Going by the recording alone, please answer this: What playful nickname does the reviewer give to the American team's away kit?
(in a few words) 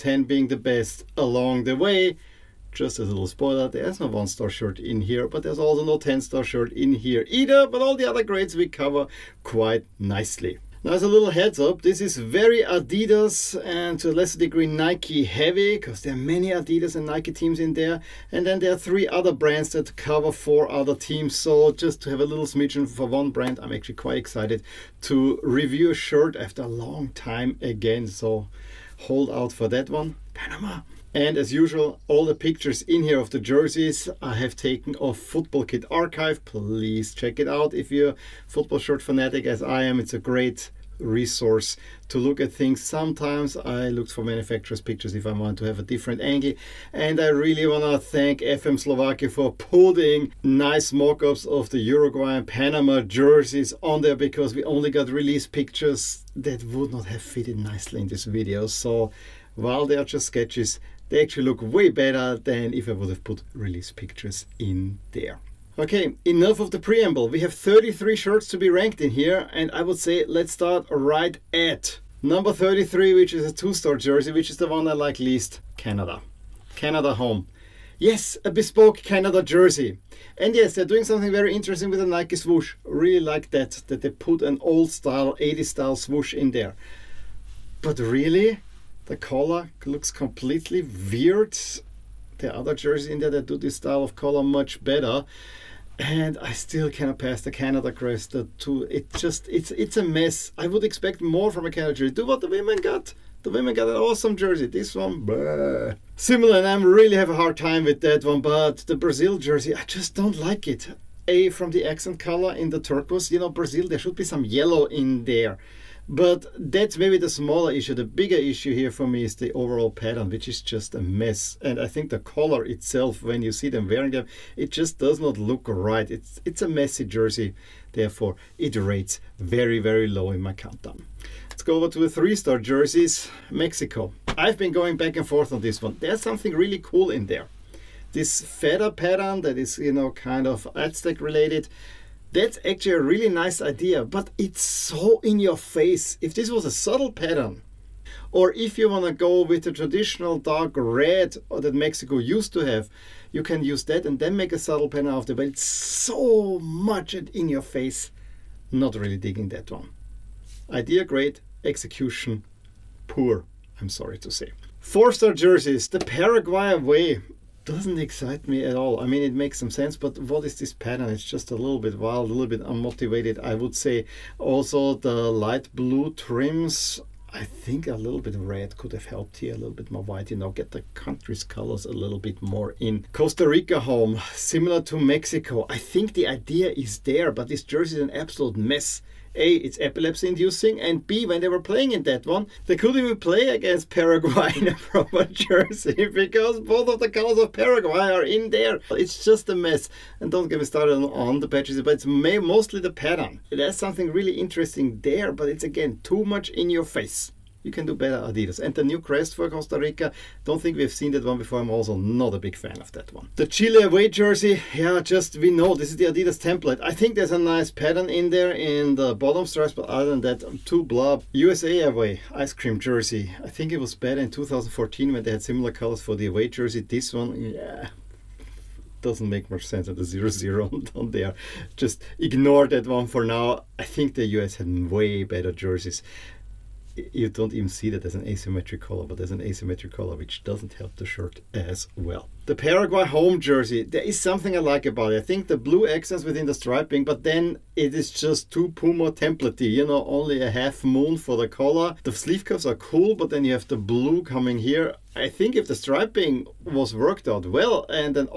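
Ice cream jersey.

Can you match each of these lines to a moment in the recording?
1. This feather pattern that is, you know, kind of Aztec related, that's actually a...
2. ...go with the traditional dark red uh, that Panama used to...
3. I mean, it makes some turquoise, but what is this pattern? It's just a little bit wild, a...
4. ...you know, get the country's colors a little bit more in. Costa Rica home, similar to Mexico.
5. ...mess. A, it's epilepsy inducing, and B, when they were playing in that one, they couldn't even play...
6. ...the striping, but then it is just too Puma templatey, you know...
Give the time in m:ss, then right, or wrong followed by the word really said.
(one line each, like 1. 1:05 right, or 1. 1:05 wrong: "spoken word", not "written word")
1. 2:18 right
2. 2:29 wrong: "Mexico", not "Panama"
3. 2:49 wrong: "sense", not "turquoise"
4. 3:00 right
5. 3:08 right
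6. 4:06 right.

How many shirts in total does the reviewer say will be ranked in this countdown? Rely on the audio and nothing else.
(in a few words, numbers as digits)
33.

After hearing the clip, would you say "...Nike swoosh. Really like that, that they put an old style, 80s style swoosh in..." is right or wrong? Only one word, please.
right.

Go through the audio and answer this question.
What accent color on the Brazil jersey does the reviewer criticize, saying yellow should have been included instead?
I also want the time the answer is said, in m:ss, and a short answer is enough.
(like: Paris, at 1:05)
Turquoise, at 1:52.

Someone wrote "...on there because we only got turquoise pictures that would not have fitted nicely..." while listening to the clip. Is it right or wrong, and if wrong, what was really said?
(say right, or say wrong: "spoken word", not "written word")
wrong: "release", not "turquoise".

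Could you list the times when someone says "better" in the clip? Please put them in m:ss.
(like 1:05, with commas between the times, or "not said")
1:01, 1:34, 3:27, 3:43, 3:55.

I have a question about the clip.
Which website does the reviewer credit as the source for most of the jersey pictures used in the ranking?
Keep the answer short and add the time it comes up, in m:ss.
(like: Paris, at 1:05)
Football Kit Archive, at 0:35.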